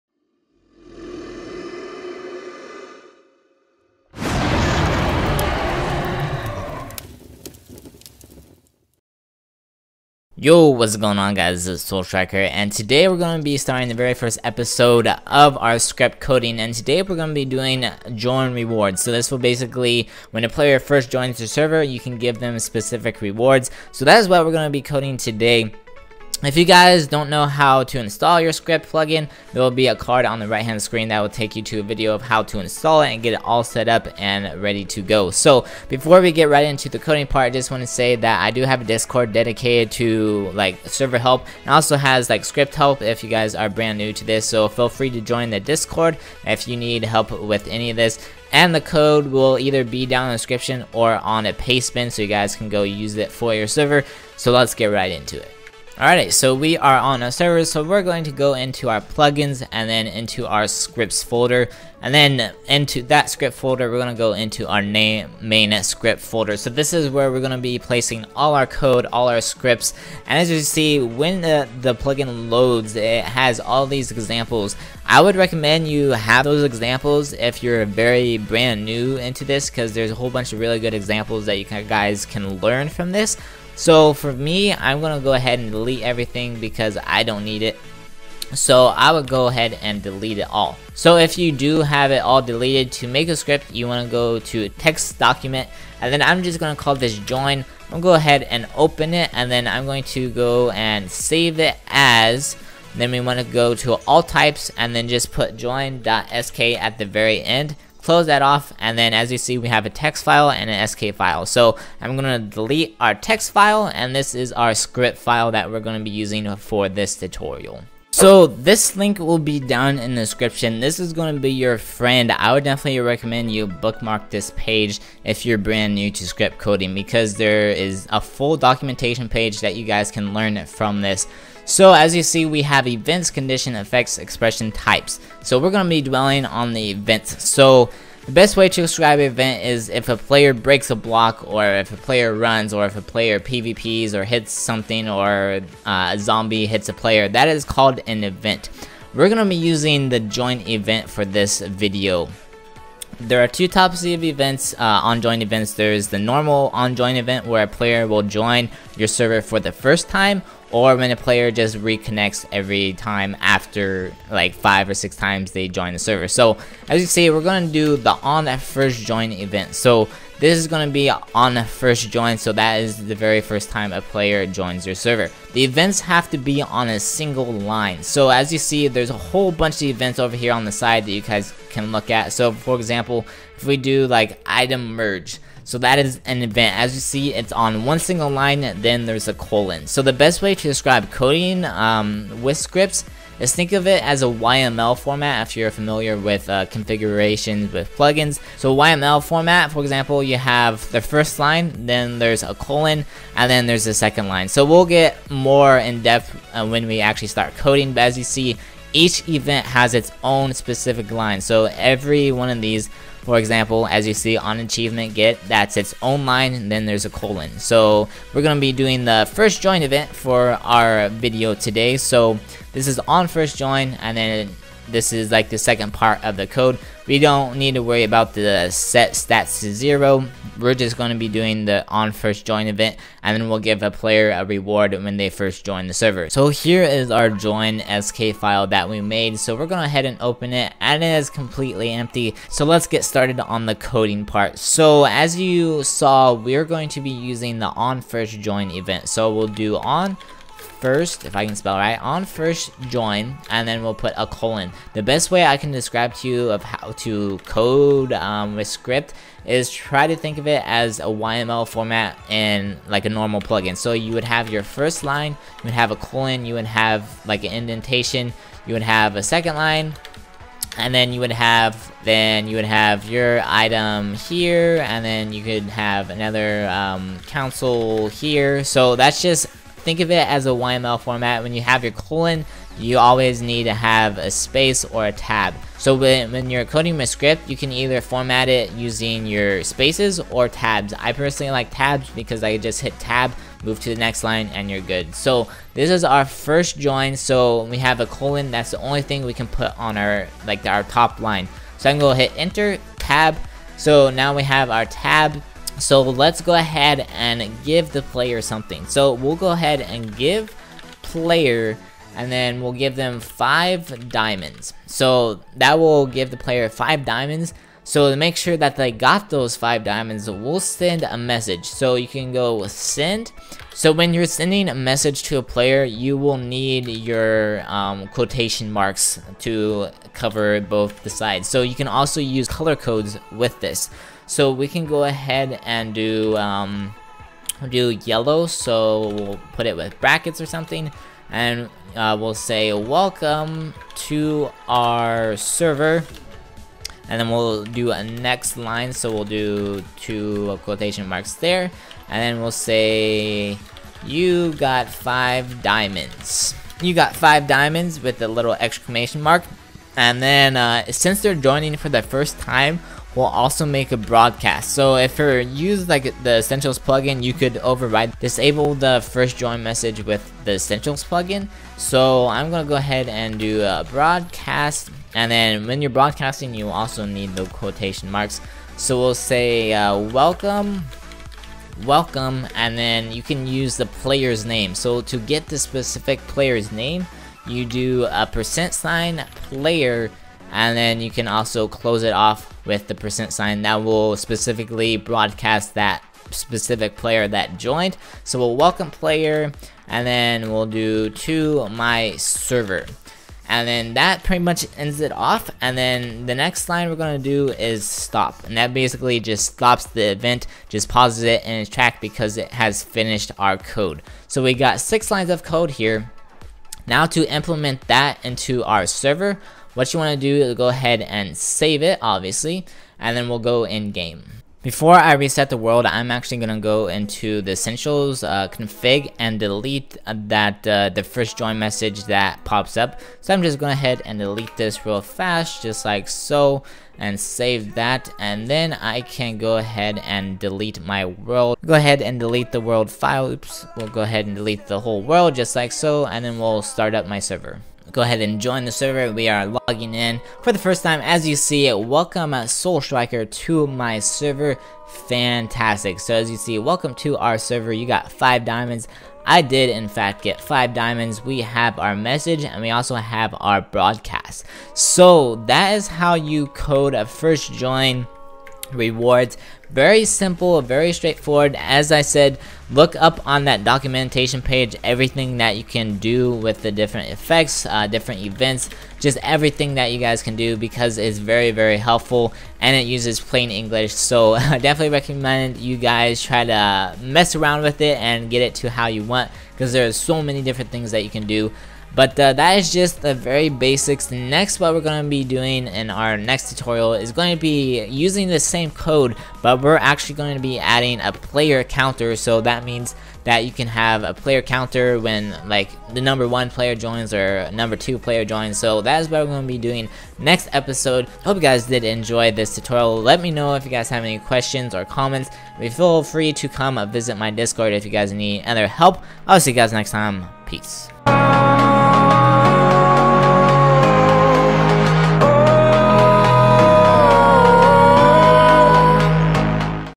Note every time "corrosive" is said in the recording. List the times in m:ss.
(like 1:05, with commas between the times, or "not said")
not said.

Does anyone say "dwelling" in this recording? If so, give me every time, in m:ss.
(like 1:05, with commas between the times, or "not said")
2:16.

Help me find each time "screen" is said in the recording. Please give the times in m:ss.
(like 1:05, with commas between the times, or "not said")
0:30.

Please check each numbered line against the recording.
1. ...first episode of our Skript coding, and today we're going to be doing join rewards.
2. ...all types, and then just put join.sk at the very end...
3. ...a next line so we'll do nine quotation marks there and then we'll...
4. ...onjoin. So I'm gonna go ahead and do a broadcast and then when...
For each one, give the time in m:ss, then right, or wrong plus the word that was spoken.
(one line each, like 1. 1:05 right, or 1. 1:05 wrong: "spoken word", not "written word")
1. 0:14 right
2. 1:44 right
3. 5:47 wrong: "two", not "nine"
4. 6:11 wrong: "plugin", not "onjoin".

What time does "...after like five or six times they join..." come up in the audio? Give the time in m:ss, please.
2:43.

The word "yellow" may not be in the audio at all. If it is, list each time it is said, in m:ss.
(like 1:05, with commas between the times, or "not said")
5:38.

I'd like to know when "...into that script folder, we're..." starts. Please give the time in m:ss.
1:02.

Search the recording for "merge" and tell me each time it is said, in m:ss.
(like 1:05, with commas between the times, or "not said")
3:04.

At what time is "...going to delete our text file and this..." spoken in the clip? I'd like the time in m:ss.
1:52.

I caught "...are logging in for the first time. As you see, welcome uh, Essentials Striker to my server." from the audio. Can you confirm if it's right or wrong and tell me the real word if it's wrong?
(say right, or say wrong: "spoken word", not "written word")
wrong: "Soul", not "Essentials".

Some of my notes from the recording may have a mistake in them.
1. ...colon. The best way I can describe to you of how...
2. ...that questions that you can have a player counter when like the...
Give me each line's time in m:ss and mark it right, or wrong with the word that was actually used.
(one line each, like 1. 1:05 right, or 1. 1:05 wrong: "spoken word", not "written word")
1. 4:14 right
2. 8:22 wrong: "means", not "questions".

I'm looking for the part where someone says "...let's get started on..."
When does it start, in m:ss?
4:02.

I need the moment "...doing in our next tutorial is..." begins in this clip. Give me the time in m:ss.
8:15.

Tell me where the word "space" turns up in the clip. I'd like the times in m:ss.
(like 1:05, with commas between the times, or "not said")
4:44, 4:49.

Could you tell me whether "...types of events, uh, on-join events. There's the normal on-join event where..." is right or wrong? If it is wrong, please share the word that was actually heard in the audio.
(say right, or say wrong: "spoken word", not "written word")
right.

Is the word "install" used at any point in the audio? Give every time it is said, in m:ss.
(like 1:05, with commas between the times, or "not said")
0:27, 0:32.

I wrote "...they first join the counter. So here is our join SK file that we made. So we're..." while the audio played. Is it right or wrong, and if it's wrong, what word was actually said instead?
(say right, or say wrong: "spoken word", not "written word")
wrong: "server", not "counter".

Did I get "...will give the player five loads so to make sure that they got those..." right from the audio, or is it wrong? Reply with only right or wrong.
wrong.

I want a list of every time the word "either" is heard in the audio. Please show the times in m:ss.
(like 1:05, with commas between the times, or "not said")
0:49, 4:47.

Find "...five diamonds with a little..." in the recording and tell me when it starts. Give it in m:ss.
5:57.